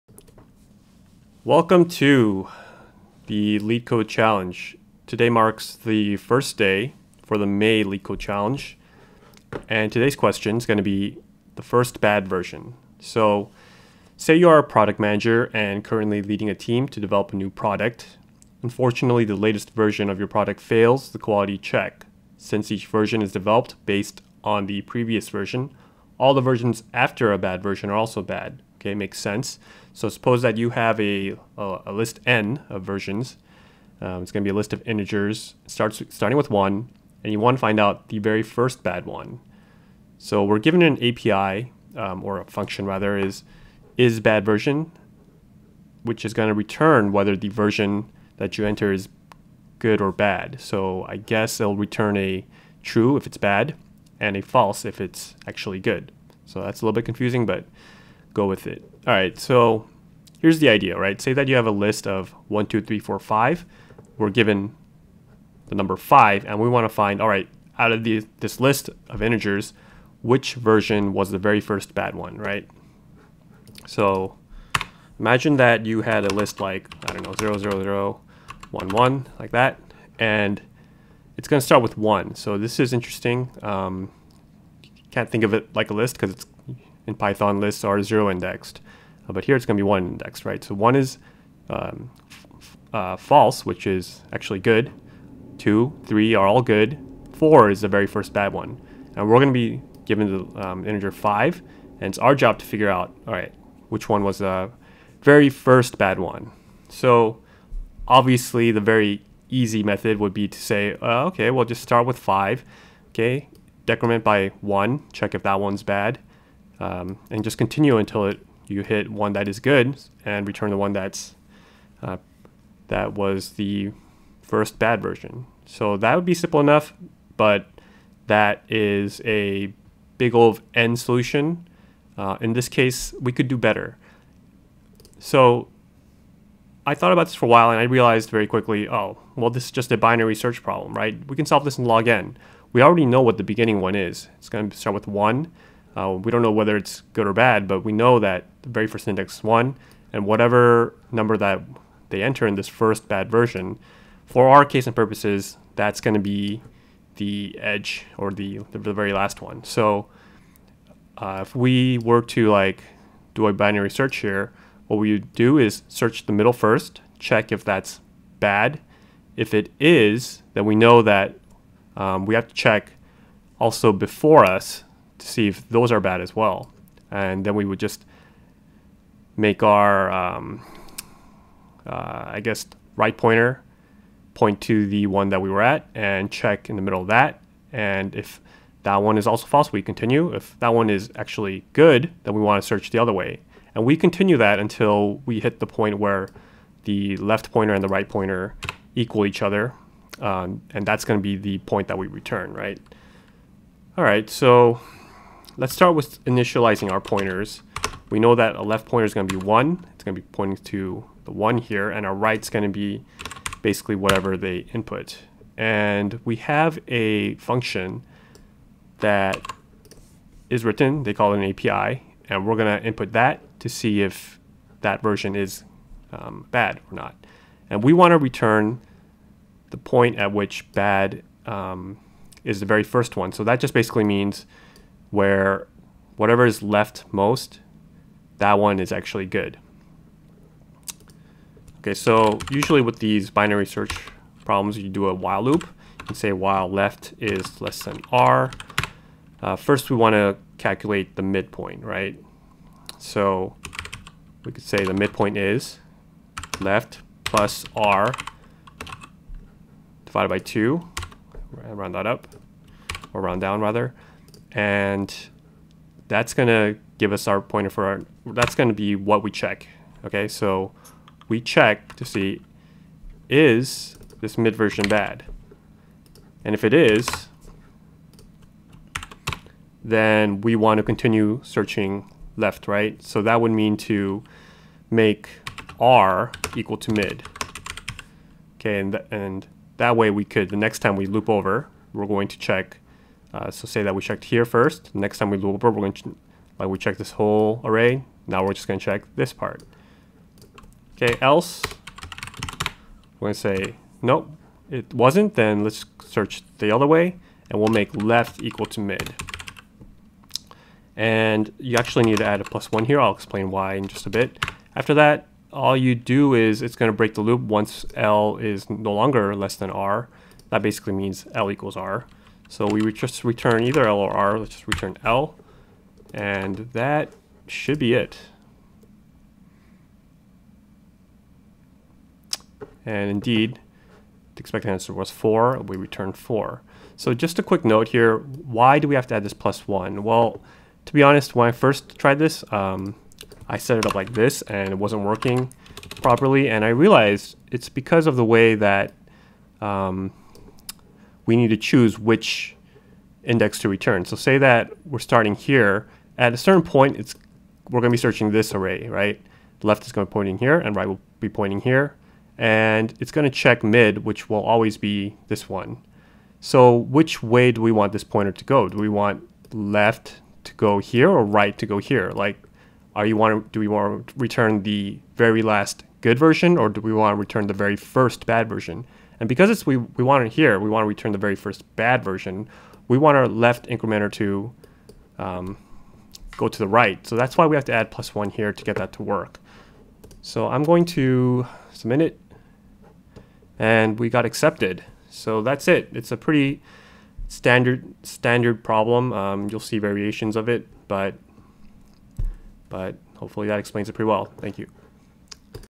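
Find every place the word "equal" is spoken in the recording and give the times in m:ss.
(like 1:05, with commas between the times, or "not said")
3:18, 4:46, 5:08, 5:21.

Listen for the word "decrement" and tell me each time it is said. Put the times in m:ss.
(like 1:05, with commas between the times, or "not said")
1:53.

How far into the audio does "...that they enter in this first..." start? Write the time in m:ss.
2:31.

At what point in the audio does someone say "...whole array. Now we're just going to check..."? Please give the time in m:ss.
4:57.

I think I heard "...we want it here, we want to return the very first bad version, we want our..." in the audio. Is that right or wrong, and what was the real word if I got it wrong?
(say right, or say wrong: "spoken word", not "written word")
right.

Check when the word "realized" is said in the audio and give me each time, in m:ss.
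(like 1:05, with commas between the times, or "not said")
2:17, 5:46.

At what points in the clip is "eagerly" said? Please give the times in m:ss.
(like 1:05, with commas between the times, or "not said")
not said.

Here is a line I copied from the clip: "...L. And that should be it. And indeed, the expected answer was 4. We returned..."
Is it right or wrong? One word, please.
right.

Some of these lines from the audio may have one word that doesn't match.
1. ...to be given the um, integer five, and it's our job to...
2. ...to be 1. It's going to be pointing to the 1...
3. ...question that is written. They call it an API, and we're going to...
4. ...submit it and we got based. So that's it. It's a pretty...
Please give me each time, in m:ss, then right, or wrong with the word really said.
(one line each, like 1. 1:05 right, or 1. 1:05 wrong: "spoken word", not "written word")
1. 1:39 right
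2. 3:29 right
3. 3:37 wrong: "function", not "question"
4. 6:31 wrong: "accepted", not "based".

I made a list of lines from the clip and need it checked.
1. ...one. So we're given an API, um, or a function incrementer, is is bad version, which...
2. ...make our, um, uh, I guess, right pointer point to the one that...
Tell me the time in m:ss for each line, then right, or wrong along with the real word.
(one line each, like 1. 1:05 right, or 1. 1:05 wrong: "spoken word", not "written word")
1. 0:39 wrong: "rather", not "incrementer"
2. 2:59 right.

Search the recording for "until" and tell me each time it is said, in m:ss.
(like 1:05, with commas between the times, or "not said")
1:57, 3:14.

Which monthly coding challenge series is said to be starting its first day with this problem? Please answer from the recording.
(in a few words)
May.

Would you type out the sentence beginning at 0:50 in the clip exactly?
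So I guess it'll return a true if it's bad, and a false if it's actually good.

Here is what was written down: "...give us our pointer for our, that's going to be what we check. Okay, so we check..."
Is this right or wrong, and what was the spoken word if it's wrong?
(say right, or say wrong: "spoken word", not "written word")
right.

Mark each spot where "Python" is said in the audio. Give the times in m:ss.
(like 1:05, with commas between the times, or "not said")
1:27.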